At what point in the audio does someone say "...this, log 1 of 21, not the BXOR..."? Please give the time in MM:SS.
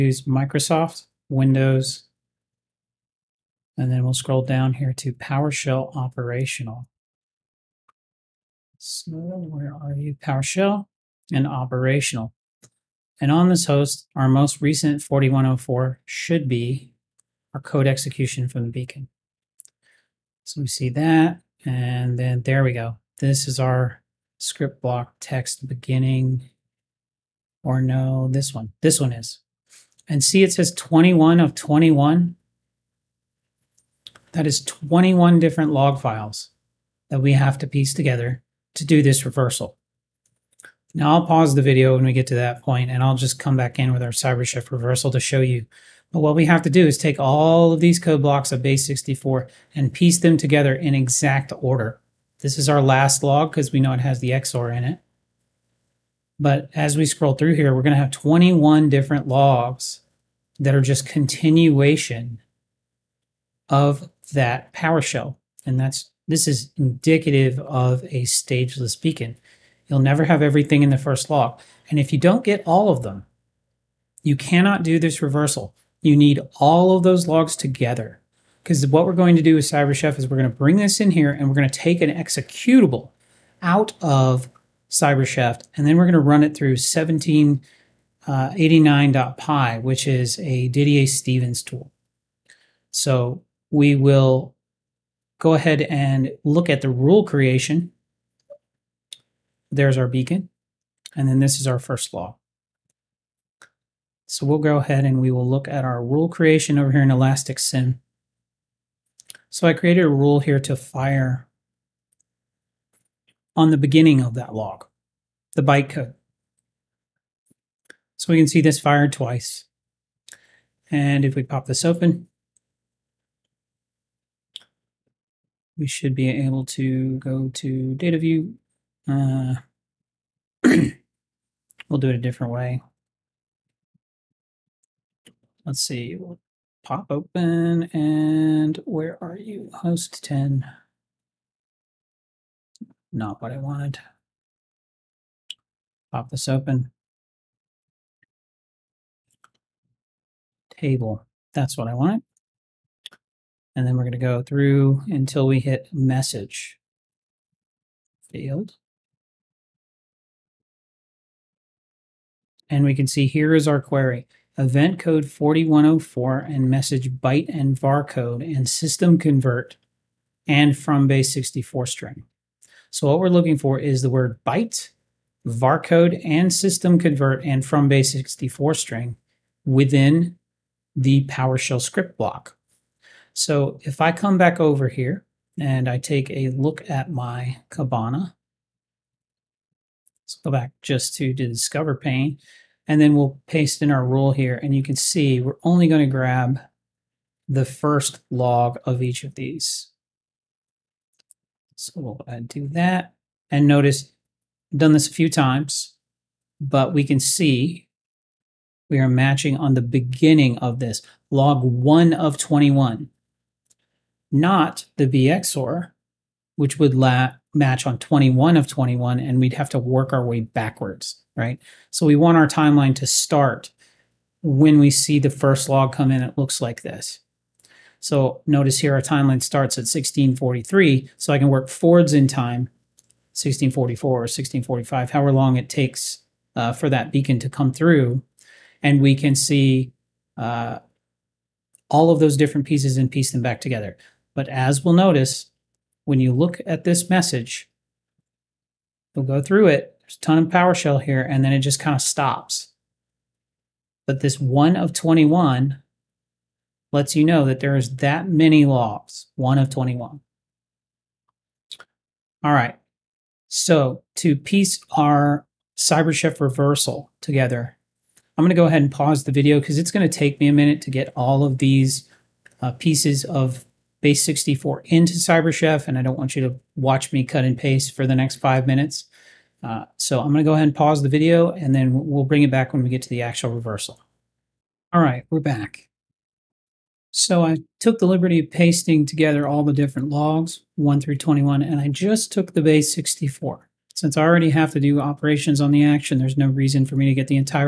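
03:30.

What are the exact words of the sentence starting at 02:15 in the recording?
Let's see, we'll pop open and where are you?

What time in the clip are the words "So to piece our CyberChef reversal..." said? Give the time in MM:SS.
04:23.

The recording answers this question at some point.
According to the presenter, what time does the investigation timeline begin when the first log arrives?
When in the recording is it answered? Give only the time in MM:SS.
03:49.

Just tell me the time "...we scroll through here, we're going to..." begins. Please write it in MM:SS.
00:56.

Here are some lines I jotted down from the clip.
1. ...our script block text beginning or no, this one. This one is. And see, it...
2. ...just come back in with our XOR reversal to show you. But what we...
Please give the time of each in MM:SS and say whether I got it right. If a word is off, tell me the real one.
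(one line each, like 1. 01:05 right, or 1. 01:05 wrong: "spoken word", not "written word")
1. 00:23 right
2. 00:43 wrong: "CyberShift", not "XOR".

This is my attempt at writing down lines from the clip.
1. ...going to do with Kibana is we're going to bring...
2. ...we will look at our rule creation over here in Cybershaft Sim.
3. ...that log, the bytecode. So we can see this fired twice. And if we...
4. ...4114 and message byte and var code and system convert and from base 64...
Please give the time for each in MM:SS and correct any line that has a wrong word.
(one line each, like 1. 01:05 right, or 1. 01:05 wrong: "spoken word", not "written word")
1. 01:19 wrong: "CyberChef", not "Kibana"
2. 01:45 wrong: "Elastic", not "Cybershaft"
3. 01:54 right
4. 02:45 wrong: "4104", not "4114".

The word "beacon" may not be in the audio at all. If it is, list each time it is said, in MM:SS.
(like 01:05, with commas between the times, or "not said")
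00:18, 01:08, 01:40, 03:57.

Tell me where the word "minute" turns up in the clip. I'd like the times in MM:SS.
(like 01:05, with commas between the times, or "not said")
04:30, 04:38.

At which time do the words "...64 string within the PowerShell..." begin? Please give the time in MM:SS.
02:58.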